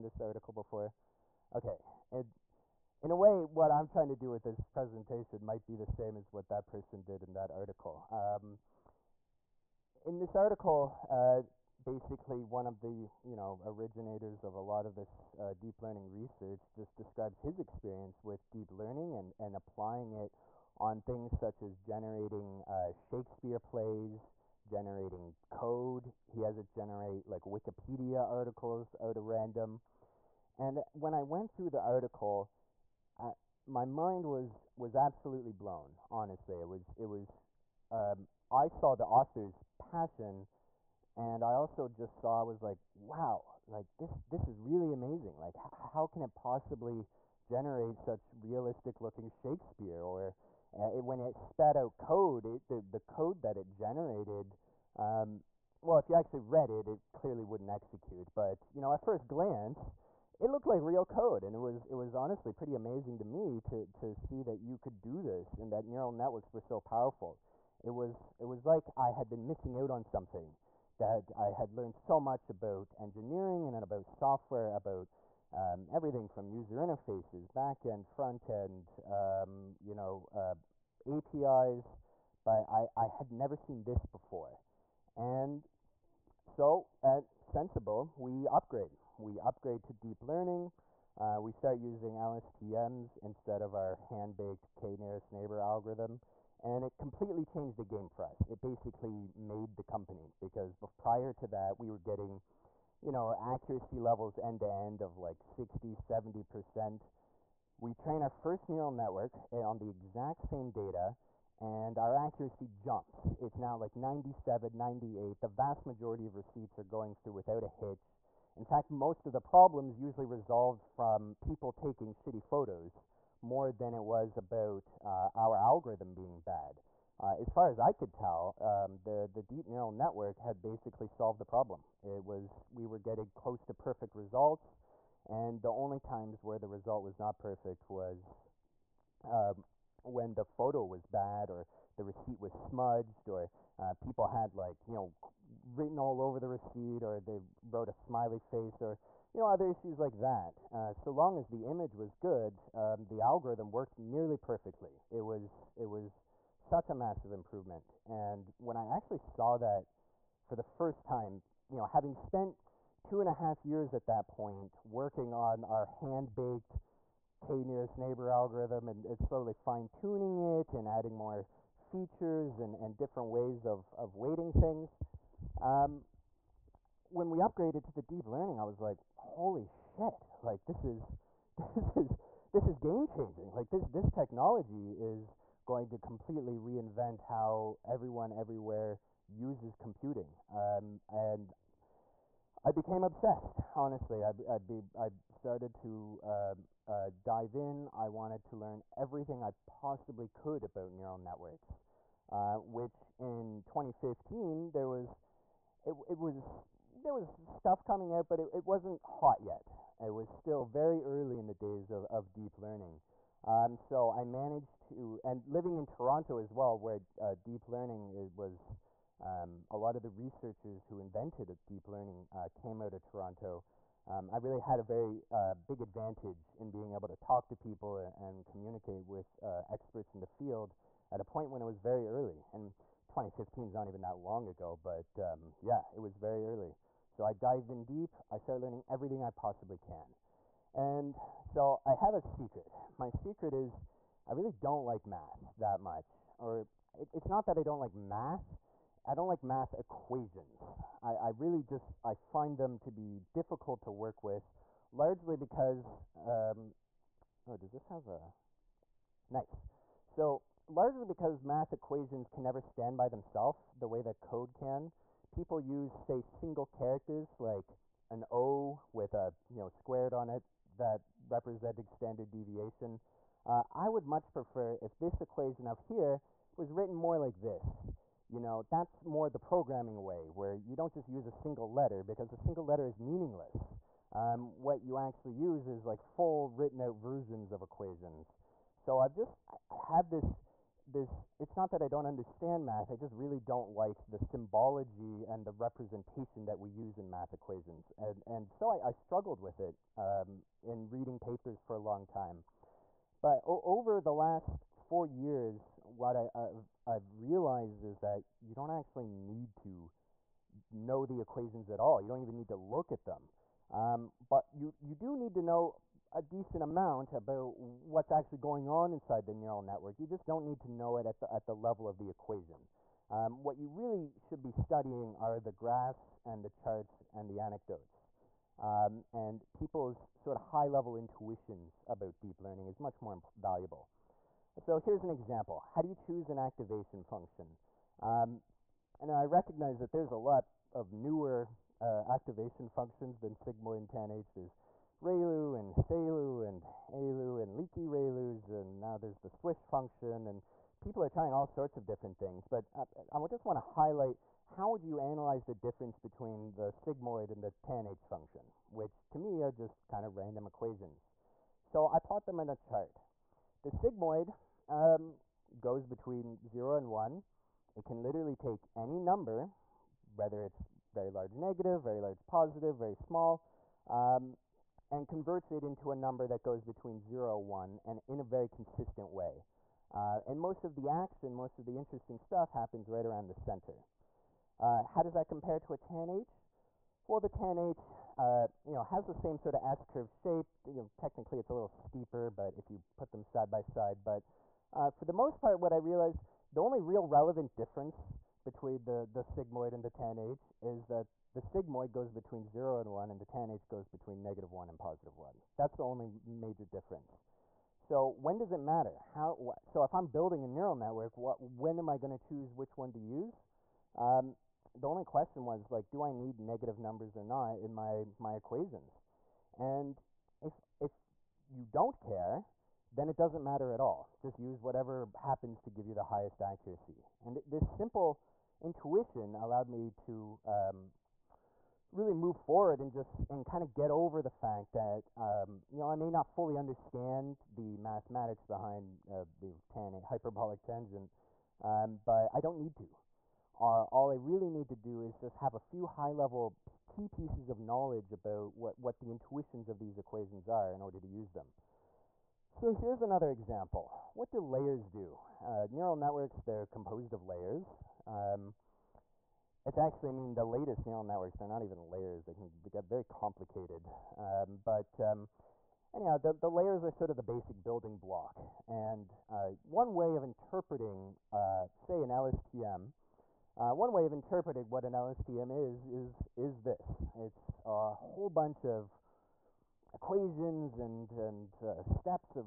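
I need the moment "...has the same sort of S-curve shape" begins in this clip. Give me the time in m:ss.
6:28.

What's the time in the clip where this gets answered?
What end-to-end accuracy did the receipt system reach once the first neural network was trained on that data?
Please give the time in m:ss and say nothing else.
1:53.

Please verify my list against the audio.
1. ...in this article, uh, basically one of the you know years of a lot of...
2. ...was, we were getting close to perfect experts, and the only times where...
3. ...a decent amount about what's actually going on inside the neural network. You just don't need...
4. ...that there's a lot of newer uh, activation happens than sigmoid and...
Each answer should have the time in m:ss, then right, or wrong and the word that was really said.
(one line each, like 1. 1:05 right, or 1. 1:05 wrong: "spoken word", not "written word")
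1. 0:10 wrong: "originators", not "years"
2. 2:12 wrong: "results", not "experts"
3. 5:16 right
4. 5:39 wrong: "functions", not "happens".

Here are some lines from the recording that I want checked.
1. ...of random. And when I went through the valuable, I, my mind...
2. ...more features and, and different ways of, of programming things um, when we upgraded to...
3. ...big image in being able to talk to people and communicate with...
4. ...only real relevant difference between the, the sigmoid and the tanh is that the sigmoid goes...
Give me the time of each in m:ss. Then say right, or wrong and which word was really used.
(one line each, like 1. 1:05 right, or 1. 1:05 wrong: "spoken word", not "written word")
1. 0:29 wrong: "article", not "valuable"
2. 2:51 wrong: "weighting", not "programming"
3. 3:45 wrong: "advantage", not "image"
4. 6:36 right.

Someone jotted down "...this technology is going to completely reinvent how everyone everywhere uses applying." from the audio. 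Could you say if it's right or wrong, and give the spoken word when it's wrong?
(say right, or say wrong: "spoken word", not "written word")
wrong: "computing", not "applying".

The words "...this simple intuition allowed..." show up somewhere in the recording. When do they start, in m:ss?
7:07.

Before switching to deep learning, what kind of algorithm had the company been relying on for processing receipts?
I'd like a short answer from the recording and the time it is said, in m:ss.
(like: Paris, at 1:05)
k-nearest neighbor, at 1:34.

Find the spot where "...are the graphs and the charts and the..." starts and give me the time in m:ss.
5:25.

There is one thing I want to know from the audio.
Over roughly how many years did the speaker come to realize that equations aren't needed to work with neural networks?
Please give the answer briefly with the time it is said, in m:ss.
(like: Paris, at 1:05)
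4, at 5:04.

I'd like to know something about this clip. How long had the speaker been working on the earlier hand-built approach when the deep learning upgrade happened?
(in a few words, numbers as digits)
2.5 years.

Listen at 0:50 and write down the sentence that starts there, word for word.
Or uh, it, when it spat out code, it the the code that it generated.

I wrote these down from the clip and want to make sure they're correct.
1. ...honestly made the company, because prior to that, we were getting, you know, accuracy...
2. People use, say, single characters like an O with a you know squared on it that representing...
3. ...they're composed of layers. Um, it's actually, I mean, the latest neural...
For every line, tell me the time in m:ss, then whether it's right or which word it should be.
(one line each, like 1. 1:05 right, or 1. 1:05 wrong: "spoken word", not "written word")
1. 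1:38 wrong: "basically", not "honestly"
2. 4:25 right
3. 7:36 right.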